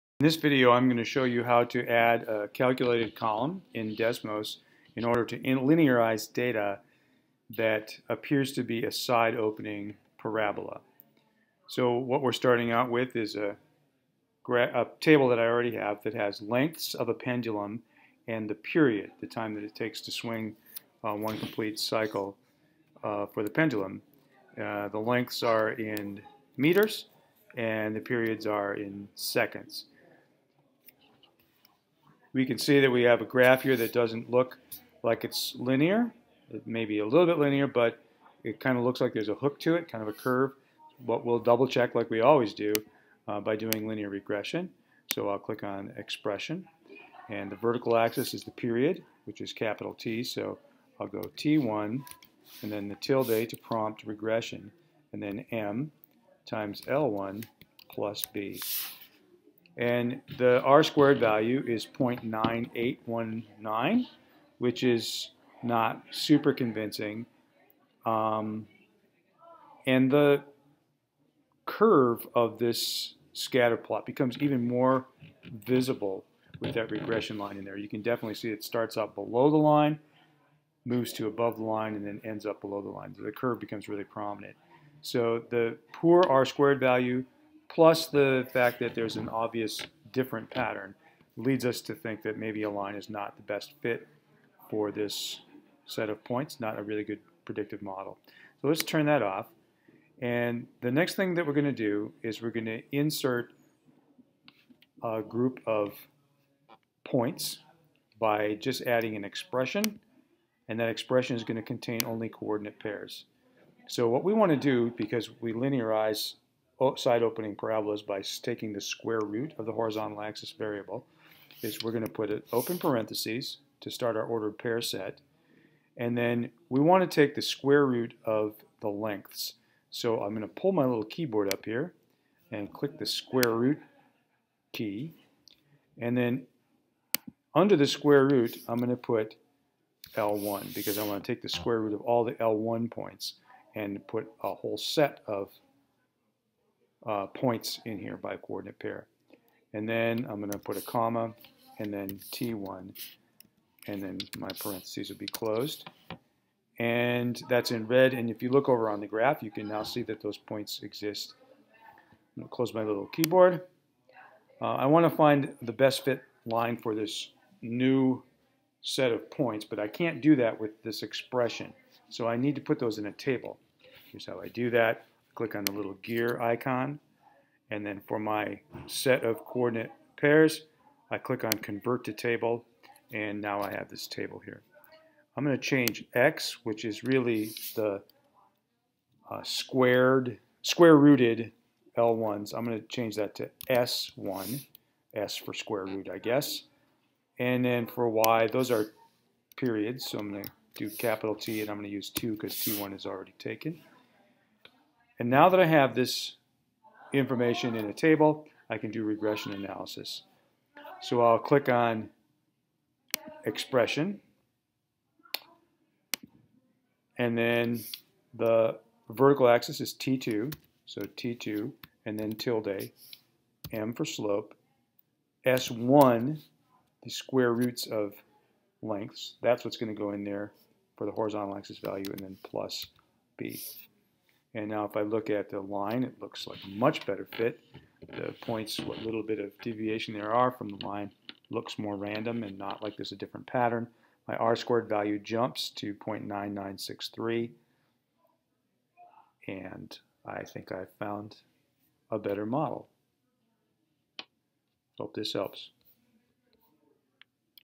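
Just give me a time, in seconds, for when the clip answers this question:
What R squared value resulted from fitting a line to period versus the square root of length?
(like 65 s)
245 s.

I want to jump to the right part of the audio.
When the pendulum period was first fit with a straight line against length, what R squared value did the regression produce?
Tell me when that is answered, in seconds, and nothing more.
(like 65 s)
61 s.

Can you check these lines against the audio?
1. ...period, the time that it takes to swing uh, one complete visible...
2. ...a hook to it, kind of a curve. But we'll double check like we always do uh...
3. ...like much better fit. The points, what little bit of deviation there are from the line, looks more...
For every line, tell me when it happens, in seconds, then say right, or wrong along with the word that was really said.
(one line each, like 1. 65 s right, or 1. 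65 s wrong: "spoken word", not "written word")
1. 18 s wrong: "cycle", not "visible"
2. 39 s right
3. 236 s right.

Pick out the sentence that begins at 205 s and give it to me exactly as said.
And now that I have this information in a table, I can do regression analysis.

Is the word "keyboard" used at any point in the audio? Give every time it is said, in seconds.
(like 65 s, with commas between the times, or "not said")
131 s, 163 s.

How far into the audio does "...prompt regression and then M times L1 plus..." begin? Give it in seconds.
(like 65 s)
53 s.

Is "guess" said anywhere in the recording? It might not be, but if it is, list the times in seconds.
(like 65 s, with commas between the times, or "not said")
196 s.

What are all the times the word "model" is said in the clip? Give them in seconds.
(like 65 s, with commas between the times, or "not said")
97 s, 252 s.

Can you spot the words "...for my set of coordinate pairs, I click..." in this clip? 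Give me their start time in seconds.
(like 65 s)
178 s.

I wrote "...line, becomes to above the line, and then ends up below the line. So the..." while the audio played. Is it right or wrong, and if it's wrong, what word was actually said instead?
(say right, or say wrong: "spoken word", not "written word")
wrong: "moves", not "becomes".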